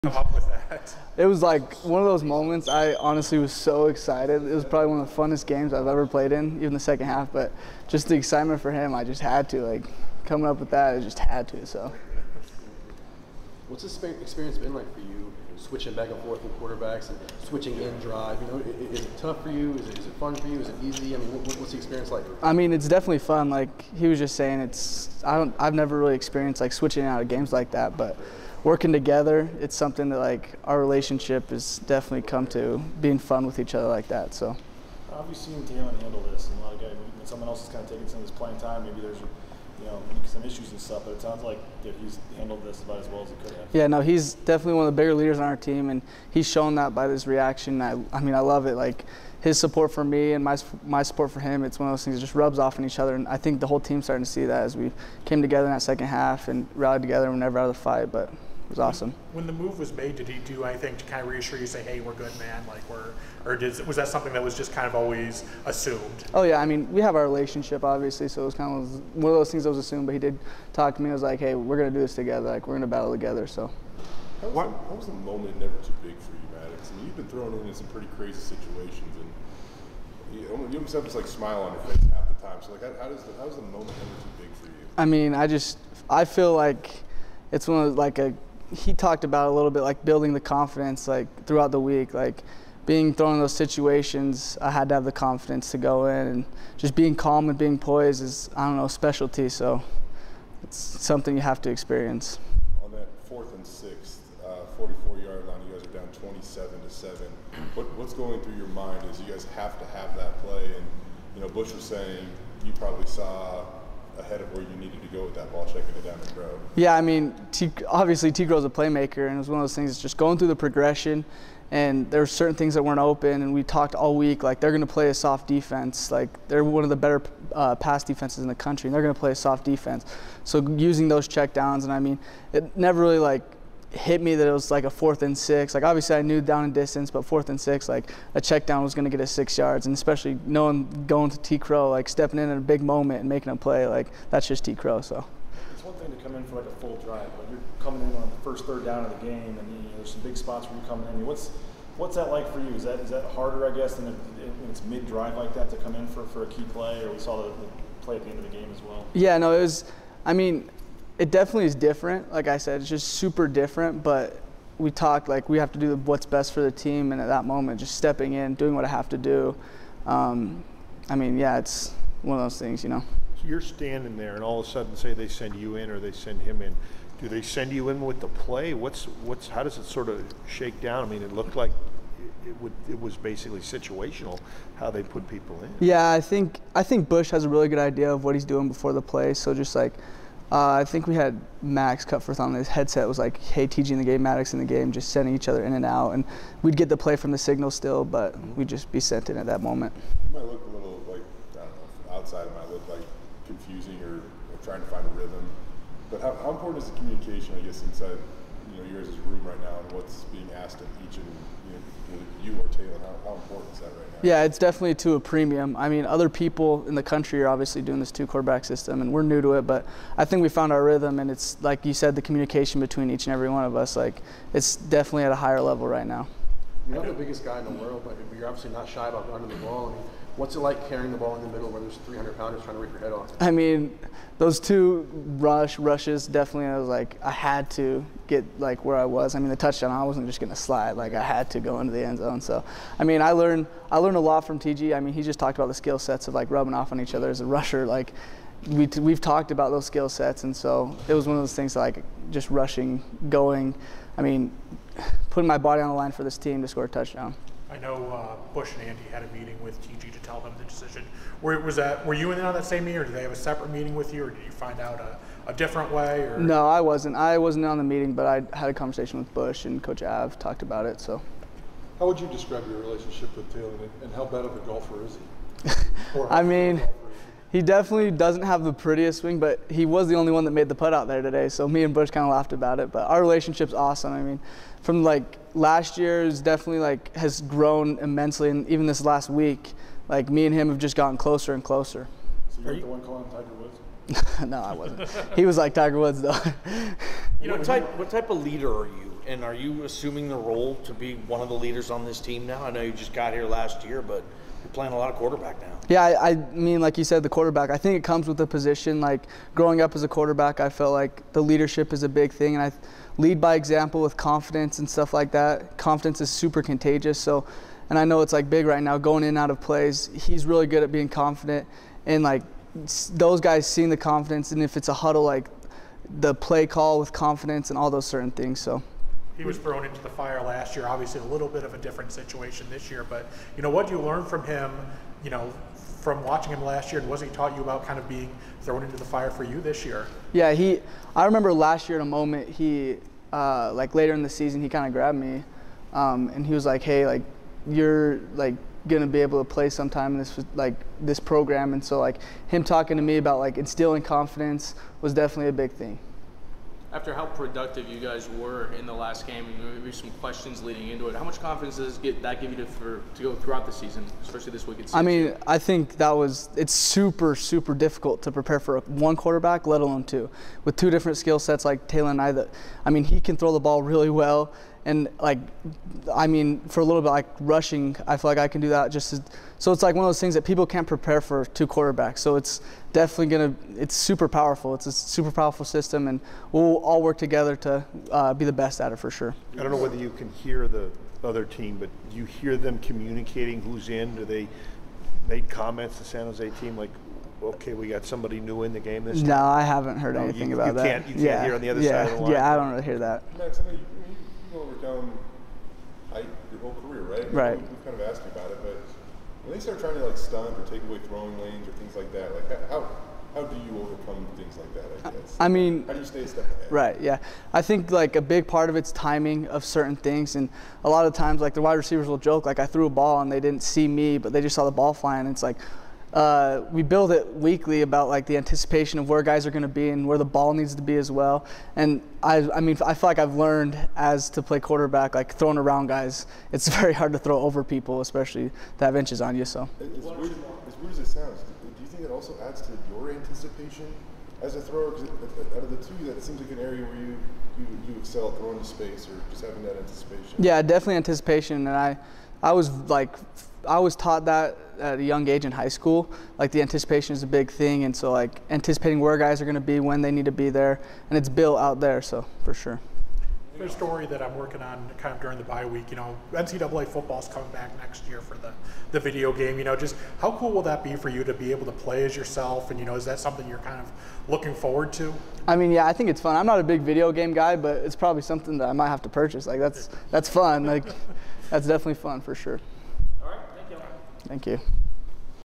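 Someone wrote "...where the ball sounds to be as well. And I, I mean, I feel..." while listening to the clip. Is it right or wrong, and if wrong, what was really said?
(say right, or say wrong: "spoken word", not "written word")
wrong: "needs", not "sounds".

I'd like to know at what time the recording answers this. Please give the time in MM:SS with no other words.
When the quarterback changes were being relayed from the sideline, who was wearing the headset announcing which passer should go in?
03:11.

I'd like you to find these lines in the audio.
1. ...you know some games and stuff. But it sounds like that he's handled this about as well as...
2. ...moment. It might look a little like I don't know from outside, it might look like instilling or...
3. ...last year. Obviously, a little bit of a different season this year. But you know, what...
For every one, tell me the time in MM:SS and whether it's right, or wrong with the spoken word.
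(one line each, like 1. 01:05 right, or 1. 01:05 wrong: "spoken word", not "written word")
1. 00:39 wrong: "issues", not "games"
2. 03:19 wrong: "confusing", not "instilling"
3. 05:30 wrong: "situation", not "season".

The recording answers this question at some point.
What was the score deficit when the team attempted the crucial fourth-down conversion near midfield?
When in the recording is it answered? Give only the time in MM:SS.
01:46.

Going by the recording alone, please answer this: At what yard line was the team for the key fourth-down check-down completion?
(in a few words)
44.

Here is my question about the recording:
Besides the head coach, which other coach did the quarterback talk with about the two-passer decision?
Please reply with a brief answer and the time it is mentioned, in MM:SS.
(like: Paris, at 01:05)
Coach Av, at 04:29.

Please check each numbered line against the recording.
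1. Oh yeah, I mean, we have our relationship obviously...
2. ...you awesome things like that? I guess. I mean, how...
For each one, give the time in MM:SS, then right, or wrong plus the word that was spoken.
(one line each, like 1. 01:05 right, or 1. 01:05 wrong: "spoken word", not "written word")
1. 01:06 right
2. 06:53 wrong: "overcome", not "awesome".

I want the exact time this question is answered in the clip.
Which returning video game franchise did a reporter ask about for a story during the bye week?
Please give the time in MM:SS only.
07:46.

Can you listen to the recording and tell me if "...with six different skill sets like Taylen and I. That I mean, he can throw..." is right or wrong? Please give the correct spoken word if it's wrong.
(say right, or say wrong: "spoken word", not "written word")
wrong: "two", not "six".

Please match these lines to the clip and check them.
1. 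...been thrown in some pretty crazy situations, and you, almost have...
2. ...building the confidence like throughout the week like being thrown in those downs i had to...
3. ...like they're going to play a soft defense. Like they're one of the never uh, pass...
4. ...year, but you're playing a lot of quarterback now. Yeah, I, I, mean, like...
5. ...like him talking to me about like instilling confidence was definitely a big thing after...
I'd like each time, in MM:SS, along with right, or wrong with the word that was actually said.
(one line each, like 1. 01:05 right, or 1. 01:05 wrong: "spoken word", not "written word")
1. 01:17 right
2. 01:30 wrong: "situations", not "downs"
3. 02:04 wrong: "better", not "never"
4. 05:03 right
5. 05:51 right.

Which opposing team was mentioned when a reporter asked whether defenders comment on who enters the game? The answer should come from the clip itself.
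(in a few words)
San Jose.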